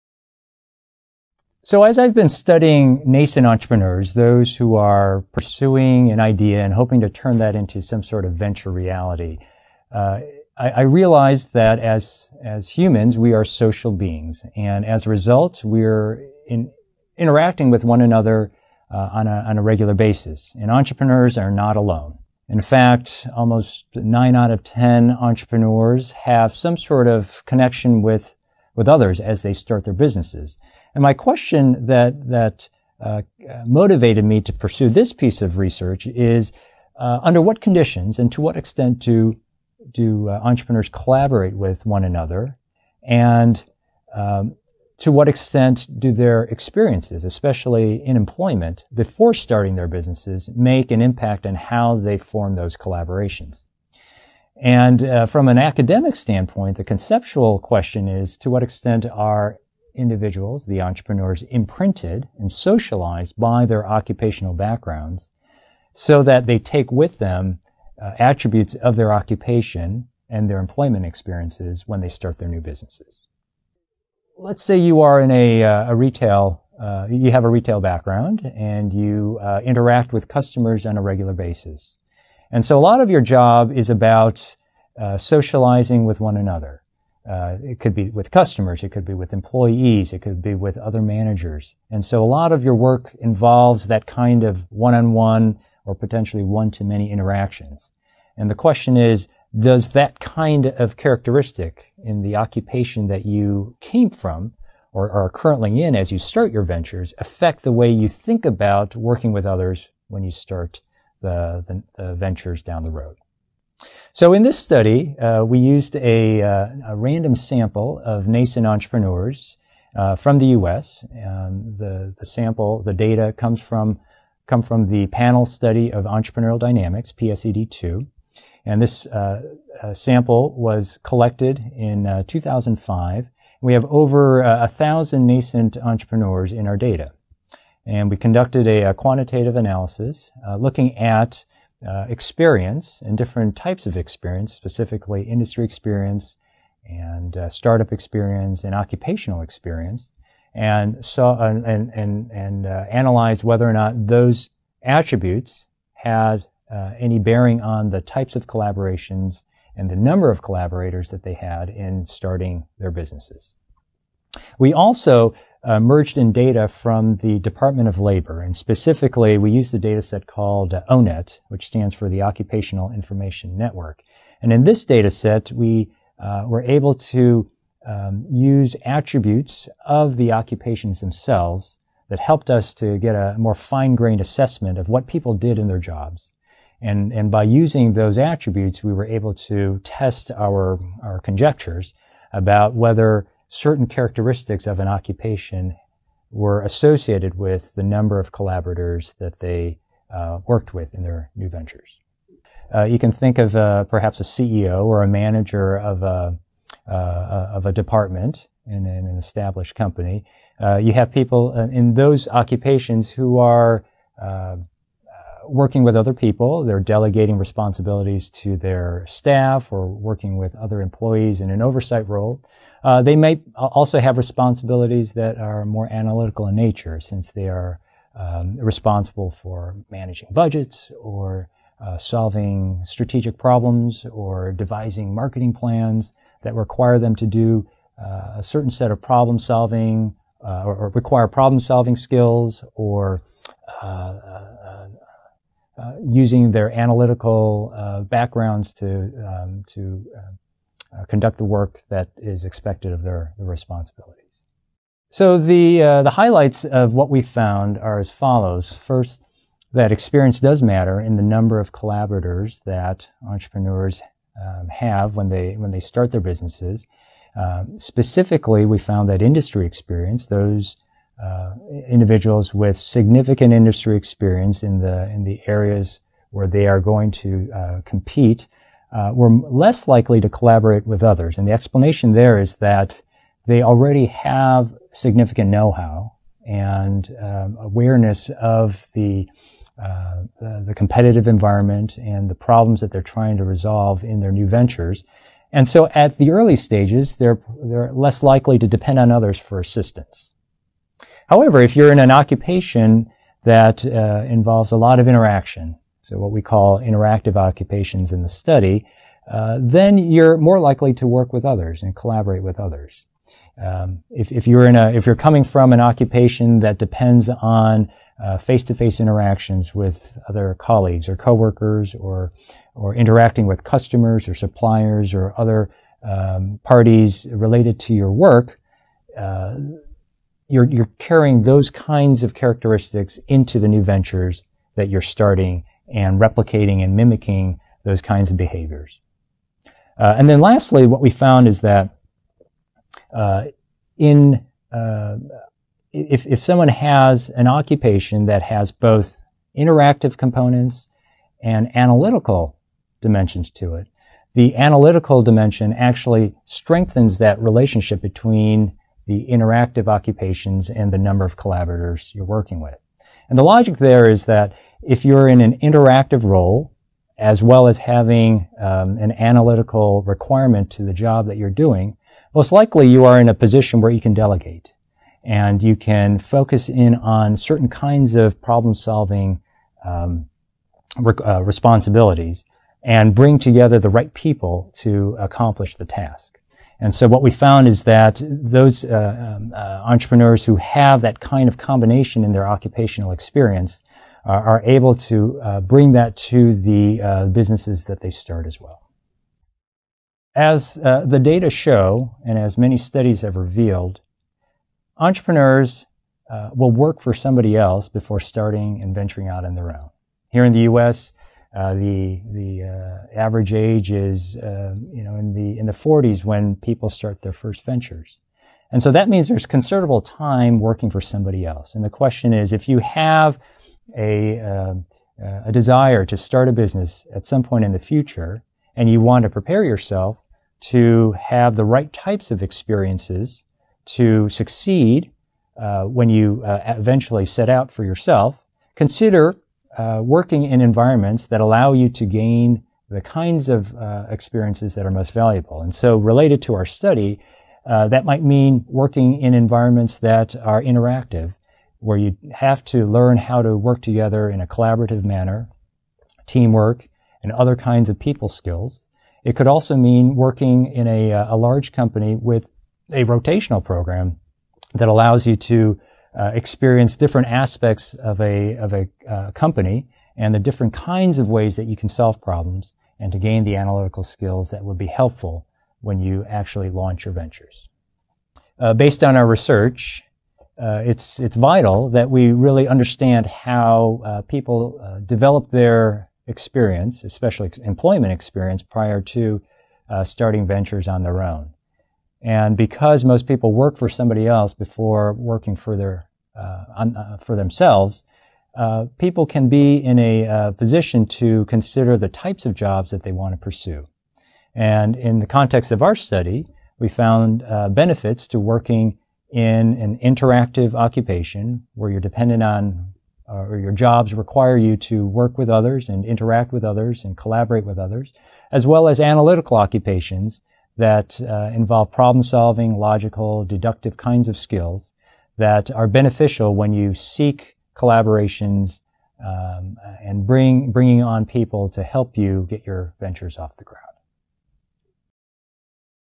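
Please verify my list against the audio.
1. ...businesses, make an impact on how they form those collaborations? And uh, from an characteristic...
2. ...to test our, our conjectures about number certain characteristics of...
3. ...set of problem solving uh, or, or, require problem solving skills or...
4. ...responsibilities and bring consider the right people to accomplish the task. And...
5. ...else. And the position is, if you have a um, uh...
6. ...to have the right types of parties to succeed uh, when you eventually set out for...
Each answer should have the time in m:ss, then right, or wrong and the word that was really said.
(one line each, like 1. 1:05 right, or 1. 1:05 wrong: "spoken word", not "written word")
1. 0:49 wrong: "academic", not "characteristic"
2. 3:09 wrong: "whether", not "number"
3. 3:58 right
4. 6:21 wrong: "together", not "consider"
5. 7:01 wrong: "question", not "position"
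6. 7:10 wrong: "experiences", not "parties".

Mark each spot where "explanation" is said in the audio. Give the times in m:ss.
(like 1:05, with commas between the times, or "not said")
4:41.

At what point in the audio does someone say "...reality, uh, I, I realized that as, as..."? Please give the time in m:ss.
0:08.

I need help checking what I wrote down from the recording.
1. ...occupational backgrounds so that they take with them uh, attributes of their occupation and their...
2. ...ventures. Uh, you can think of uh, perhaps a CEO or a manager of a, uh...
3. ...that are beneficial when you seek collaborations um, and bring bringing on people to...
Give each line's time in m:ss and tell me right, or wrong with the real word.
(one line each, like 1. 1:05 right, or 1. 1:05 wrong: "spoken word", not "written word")
1. 1:03 right
2. 3:21 right
3. 8:45 right.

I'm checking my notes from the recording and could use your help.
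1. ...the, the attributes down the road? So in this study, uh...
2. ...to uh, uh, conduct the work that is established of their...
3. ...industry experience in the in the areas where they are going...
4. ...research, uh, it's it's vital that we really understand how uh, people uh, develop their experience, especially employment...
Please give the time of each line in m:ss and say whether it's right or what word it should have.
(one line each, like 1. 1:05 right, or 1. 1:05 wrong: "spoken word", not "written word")
1. 1:51 wrong: "ventures", not "attributes"
2. 4:09 wrong: "expected", not "established"
3. 4:33 right
4. 7:59 right.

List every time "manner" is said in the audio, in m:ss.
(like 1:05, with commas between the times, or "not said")
7:35.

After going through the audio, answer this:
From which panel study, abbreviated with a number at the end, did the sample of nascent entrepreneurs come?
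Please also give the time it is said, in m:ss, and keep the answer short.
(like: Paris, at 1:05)
PSED2, at 2:07.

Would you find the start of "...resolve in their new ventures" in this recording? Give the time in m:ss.
4:53.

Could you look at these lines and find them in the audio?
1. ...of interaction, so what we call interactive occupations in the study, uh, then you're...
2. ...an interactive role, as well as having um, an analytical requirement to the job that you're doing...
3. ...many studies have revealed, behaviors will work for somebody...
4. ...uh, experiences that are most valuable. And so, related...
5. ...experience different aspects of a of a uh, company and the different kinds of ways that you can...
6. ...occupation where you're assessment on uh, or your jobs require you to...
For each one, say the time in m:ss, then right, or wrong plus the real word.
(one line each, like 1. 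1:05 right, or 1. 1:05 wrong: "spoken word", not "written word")
1. 5:04 right
2. 6:05 right
3. 6:42 wrong: "entrepreneurs", not "behaviors"
4. 7:23 right
5. 7:46 right
6. 8:30 wrong: "dependent", not "assessment".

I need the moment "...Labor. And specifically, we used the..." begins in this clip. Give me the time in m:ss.
2:47.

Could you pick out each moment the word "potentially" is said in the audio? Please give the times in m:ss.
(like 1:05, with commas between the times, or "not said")
1:35.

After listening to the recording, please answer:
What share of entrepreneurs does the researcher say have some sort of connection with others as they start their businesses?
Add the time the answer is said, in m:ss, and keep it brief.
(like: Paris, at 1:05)
9 out of 10, at 0:23.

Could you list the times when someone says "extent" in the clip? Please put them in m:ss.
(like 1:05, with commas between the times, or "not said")
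0:38, 0:45, 0:58.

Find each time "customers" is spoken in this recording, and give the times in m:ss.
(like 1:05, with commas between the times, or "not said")
1:20, 1:28, 5:23.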